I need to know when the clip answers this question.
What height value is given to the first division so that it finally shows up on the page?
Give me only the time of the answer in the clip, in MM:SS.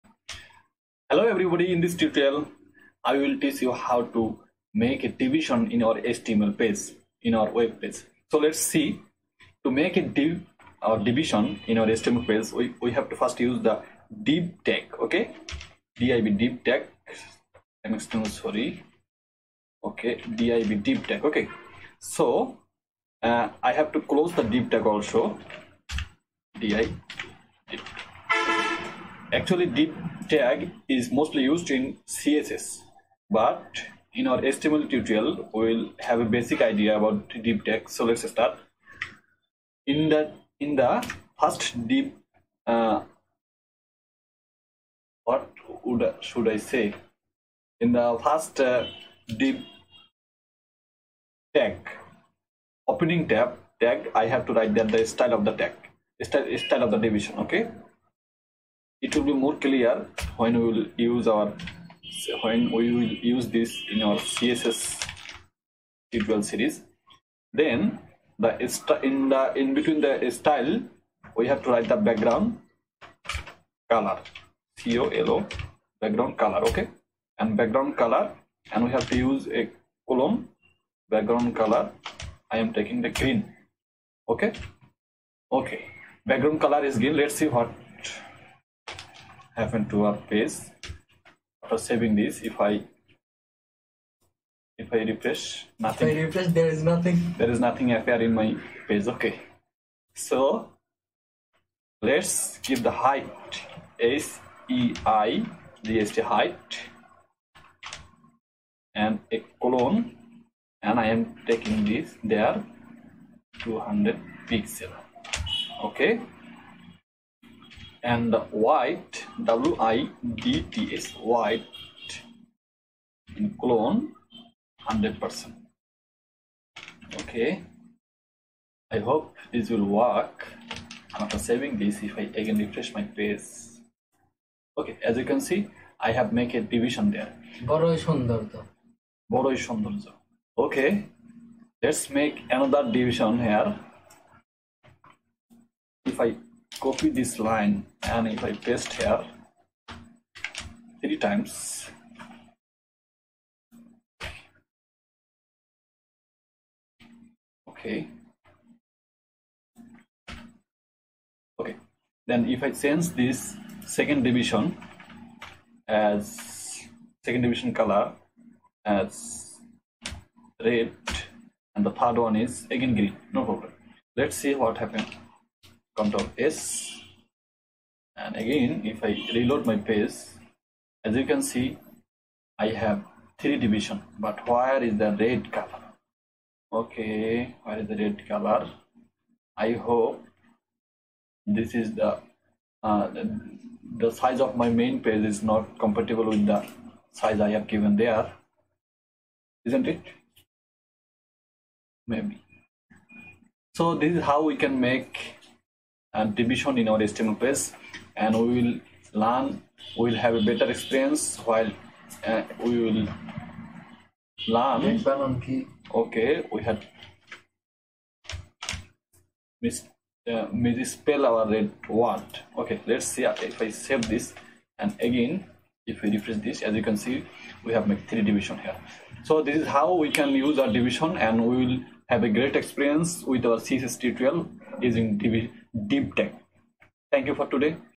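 01:53.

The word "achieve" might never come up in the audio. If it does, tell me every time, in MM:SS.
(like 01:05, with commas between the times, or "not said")
not said.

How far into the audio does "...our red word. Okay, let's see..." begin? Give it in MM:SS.
03:41.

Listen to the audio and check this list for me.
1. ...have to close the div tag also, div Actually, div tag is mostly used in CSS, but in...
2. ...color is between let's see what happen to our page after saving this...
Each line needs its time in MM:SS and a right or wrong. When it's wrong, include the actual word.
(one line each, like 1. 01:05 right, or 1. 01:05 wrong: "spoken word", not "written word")
1. 00:23 right
2. 01:26 wrong: "green", not "between".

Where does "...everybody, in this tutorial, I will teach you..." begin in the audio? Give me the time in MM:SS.
00:01.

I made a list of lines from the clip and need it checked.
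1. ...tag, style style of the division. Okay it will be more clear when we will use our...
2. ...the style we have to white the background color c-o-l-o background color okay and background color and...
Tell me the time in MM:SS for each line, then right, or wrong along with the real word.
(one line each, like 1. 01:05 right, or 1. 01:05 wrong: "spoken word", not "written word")
1. 00:55 right
2. 01:10 wrong: "write", not "white".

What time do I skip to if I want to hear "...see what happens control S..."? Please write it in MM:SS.
02:54.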